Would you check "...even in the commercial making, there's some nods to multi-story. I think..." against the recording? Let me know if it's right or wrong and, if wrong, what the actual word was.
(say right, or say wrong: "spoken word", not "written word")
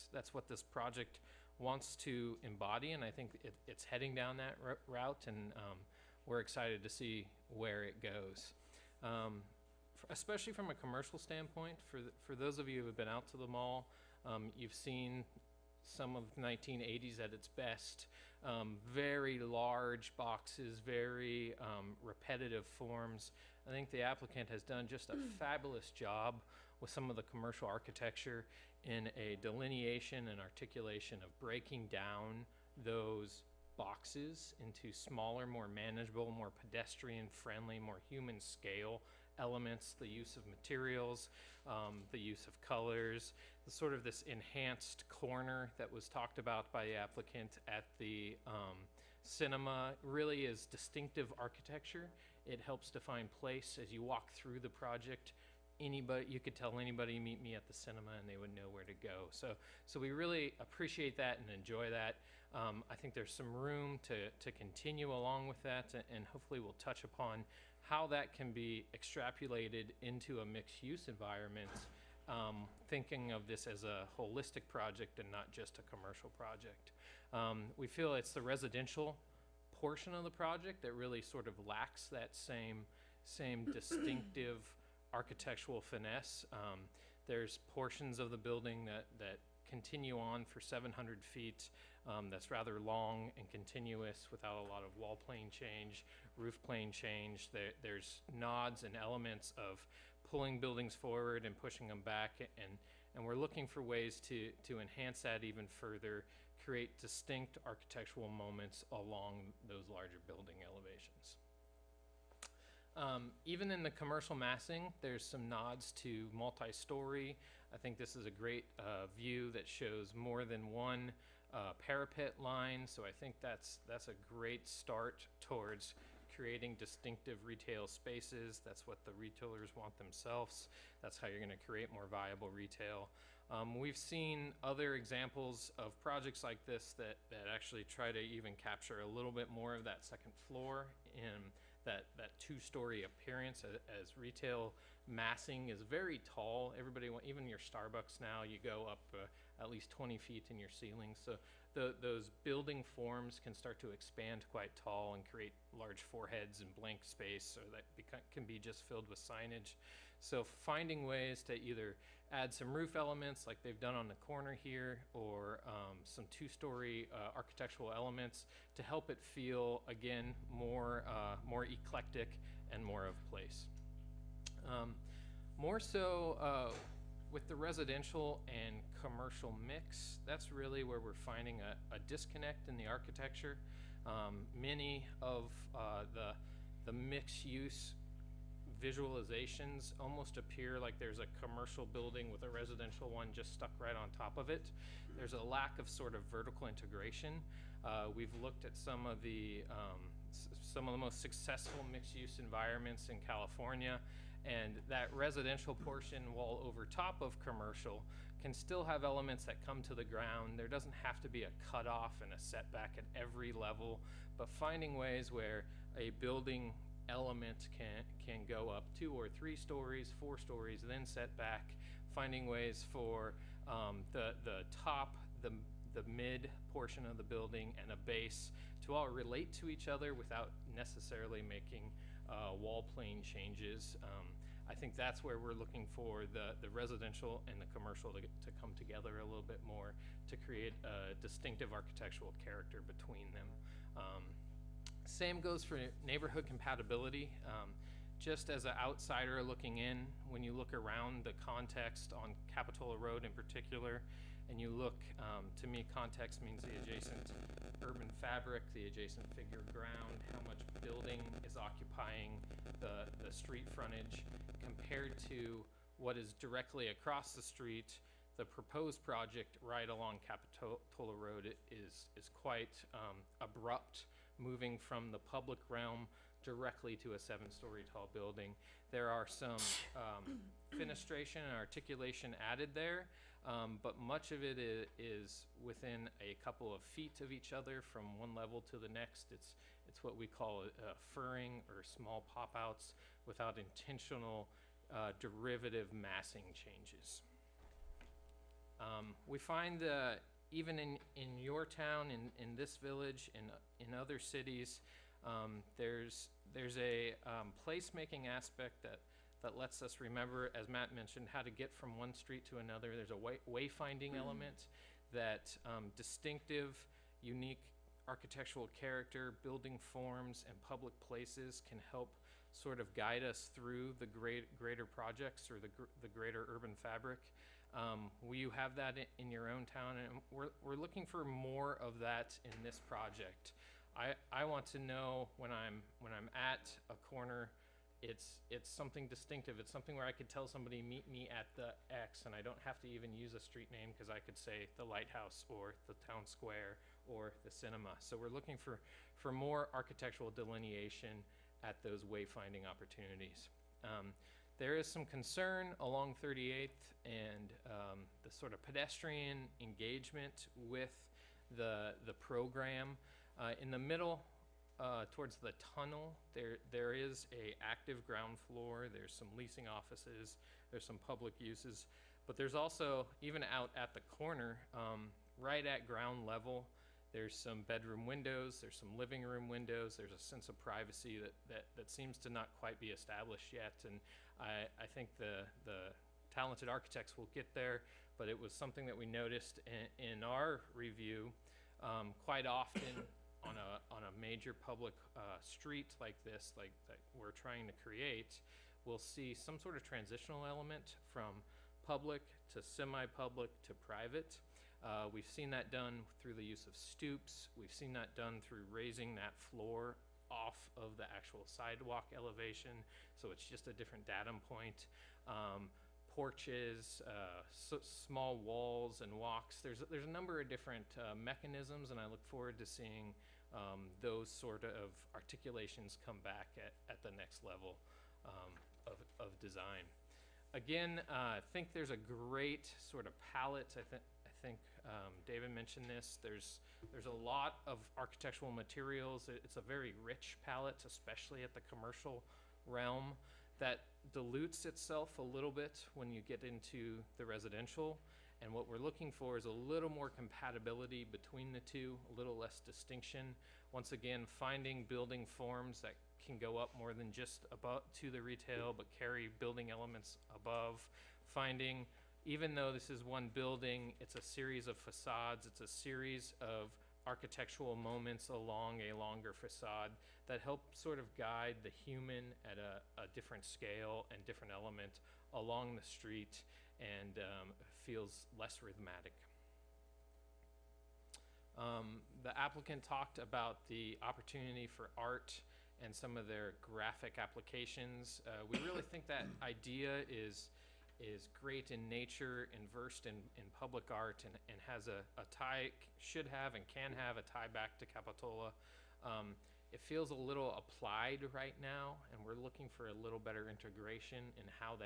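wrong: "massing", not "making".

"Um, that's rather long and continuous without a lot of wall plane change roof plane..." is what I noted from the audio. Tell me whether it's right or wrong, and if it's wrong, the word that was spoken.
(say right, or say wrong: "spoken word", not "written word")
right.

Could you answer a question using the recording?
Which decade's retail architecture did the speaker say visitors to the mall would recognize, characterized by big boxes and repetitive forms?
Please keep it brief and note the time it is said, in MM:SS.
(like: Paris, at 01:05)
1980s, at 00:16.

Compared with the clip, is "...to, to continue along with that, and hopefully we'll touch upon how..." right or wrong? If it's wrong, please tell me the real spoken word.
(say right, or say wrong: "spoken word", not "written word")
right.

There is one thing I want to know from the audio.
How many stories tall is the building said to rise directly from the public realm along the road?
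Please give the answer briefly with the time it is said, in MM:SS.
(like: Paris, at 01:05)
7, at 04:37.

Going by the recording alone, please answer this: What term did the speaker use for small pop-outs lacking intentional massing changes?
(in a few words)
furring.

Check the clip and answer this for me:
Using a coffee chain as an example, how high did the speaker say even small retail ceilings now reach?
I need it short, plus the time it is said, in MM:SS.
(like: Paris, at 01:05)
20 feet, at 02:29.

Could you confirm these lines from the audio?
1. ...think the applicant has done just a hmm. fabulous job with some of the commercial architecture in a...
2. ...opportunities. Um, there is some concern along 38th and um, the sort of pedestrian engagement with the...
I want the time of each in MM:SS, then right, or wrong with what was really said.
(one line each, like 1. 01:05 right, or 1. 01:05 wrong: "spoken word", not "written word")
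1. 00:23 right
2. 05:52 right.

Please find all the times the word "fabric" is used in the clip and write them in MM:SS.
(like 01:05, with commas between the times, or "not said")
04:18, 05:26.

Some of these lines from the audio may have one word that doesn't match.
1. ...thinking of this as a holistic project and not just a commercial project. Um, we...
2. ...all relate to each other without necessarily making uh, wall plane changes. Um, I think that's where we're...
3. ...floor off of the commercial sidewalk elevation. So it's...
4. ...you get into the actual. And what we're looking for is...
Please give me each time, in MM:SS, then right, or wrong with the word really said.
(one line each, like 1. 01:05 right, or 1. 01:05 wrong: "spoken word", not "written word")
1. 01:12 right
2. 03:48 right
3. 06:49 wrong: "actual", not "commercial"
4. 07:26 wrong: "residential", not "actual".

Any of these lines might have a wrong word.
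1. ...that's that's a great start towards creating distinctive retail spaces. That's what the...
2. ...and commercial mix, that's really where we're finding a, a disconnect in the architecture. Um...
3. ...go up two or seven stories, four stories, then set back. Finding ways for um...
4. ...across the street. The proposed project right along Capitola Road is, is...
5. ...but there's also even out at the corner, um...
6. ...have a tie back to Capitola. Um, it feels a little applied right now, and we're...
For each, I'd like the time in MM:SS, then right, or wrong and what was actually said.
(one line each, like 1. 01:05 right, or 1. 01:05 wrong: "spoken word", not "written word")
1. 02:03 right
2. 02:58 right
3. 03:38 wrong: "three", not "seven"
4. 04:26 right
5. 06:12 right
6. 08:16 right.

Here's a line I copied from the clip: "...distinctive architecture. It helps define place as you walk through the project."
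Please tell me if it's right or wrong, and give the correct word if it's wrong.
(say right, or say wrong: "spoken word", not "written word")
right.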